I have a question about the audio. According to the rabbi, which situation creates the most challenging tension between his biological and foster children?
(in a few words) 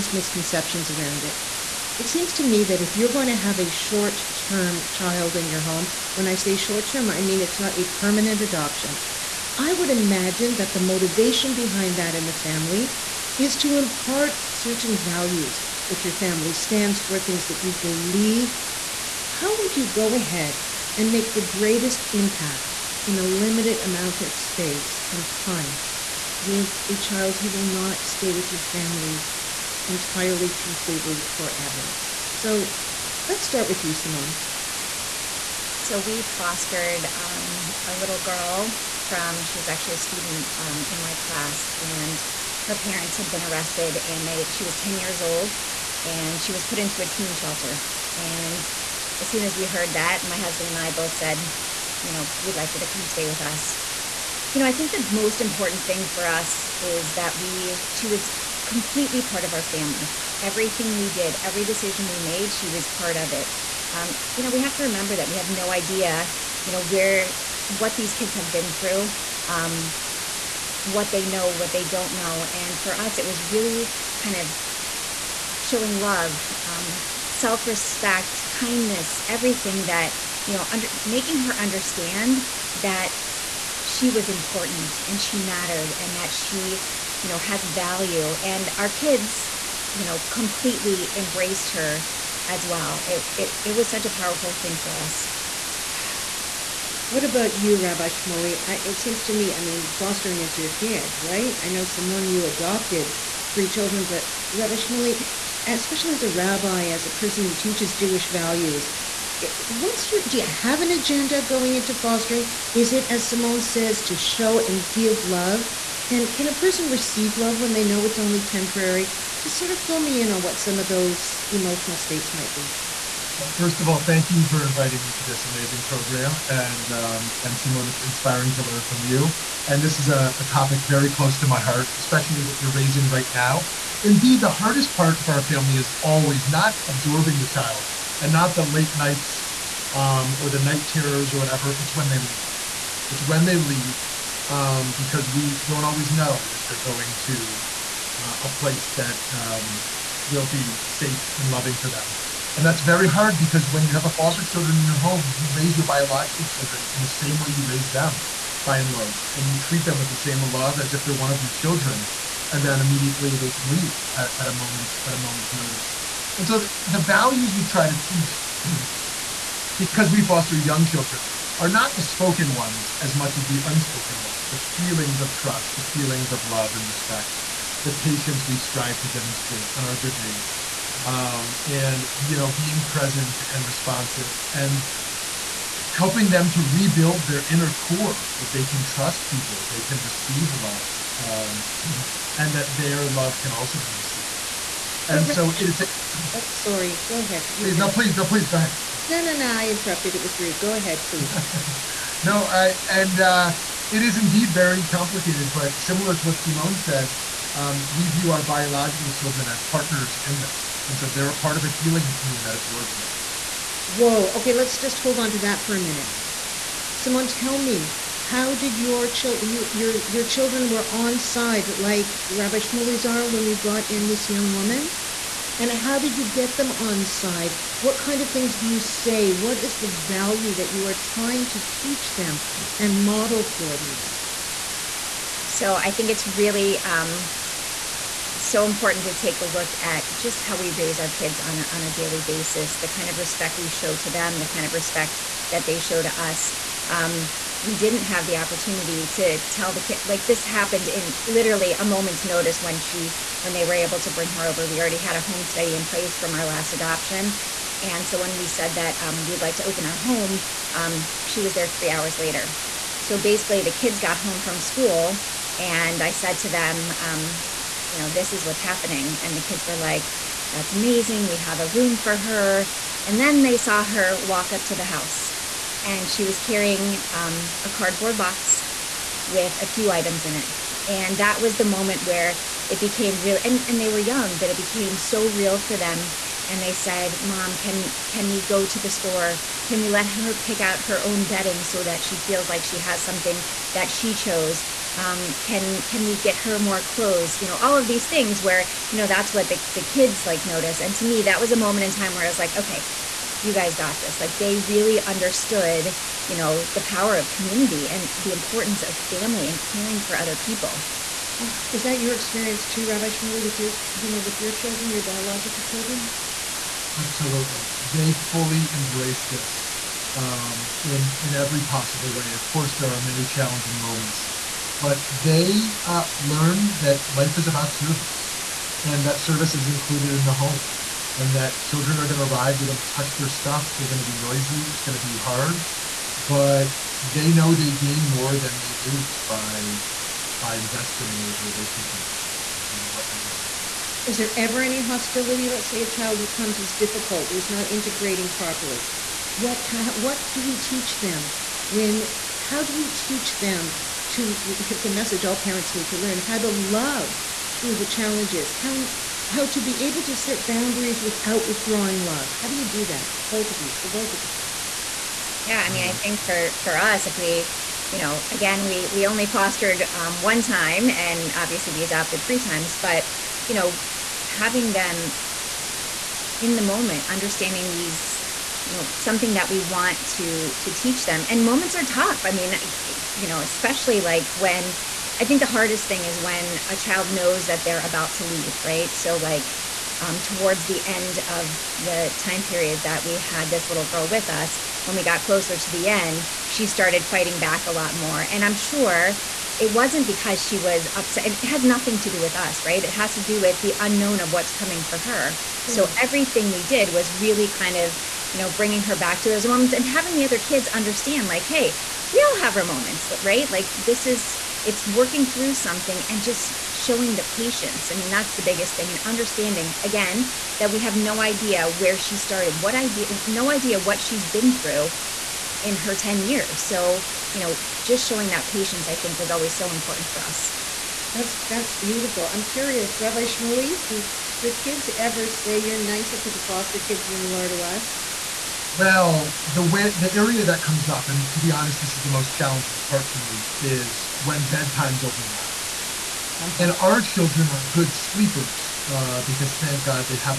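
When bedtimes overlap.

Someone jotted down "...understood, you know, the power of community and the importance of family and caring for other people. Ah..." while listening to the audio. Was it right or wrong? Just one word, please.
right.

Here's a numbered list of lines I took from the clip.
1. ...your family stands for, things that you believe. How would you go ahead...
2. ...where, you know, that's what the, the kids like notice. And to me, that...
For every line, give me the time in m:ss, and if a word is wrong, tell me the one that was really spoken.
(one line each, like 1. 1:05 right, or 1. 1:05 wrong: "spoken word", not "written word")
1. 0:16 right
2. 4:58 right.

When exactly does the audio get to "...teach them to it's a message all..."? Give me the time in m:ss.
5:52.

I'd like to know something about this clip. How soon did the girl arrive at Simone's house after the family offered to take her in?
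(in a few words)
3 hours later.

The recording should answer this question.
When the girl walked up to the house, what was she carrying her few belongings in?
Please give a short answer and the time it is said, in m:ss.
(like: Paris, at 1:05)
A cardboard box, at 4:37.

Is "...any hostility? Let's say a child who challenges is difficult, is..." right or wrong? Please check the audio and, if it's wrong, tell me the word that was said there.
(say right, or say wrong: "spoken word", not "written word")
wrong: "comes", not "challenges".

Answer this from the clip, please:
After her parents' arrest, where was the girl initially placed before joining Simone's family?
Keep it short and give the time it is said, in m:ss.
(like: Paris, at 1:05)
A teen shelter, at 0:47.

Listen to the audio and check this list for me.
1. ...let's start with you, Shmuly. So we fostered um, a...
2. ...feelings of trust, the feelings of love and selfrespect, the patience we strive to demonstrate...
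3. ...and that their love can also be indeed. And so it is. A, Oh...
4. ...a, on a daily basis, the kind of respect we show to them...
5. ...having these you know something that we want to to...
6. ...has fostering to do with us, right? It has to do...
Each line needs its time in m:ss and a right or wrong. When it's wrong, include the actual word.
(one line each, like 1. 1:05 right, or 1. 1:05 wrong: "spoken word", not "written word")
1. 0:33 wrong: "Simone", not "Shmuly"
2. 2:54 wrong: "respect", not "selfrespect"
3. 3:12 wrong: "received", not "indeed"
4. 4:01 right
5. 6:17 wrong: "understanding", not "having"
6. 6:41 wrong: "nothing", not "fostering".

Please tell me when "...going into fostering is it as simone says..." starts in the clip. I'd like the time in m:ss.
1:51.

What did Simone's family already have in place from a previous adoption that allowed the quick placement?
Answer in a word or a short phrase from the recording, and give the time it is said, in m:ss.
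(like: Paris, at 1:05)
A home study, at 4:15.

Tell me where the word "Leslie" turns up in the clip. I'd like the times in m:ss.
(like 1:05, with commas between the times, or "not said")
not said.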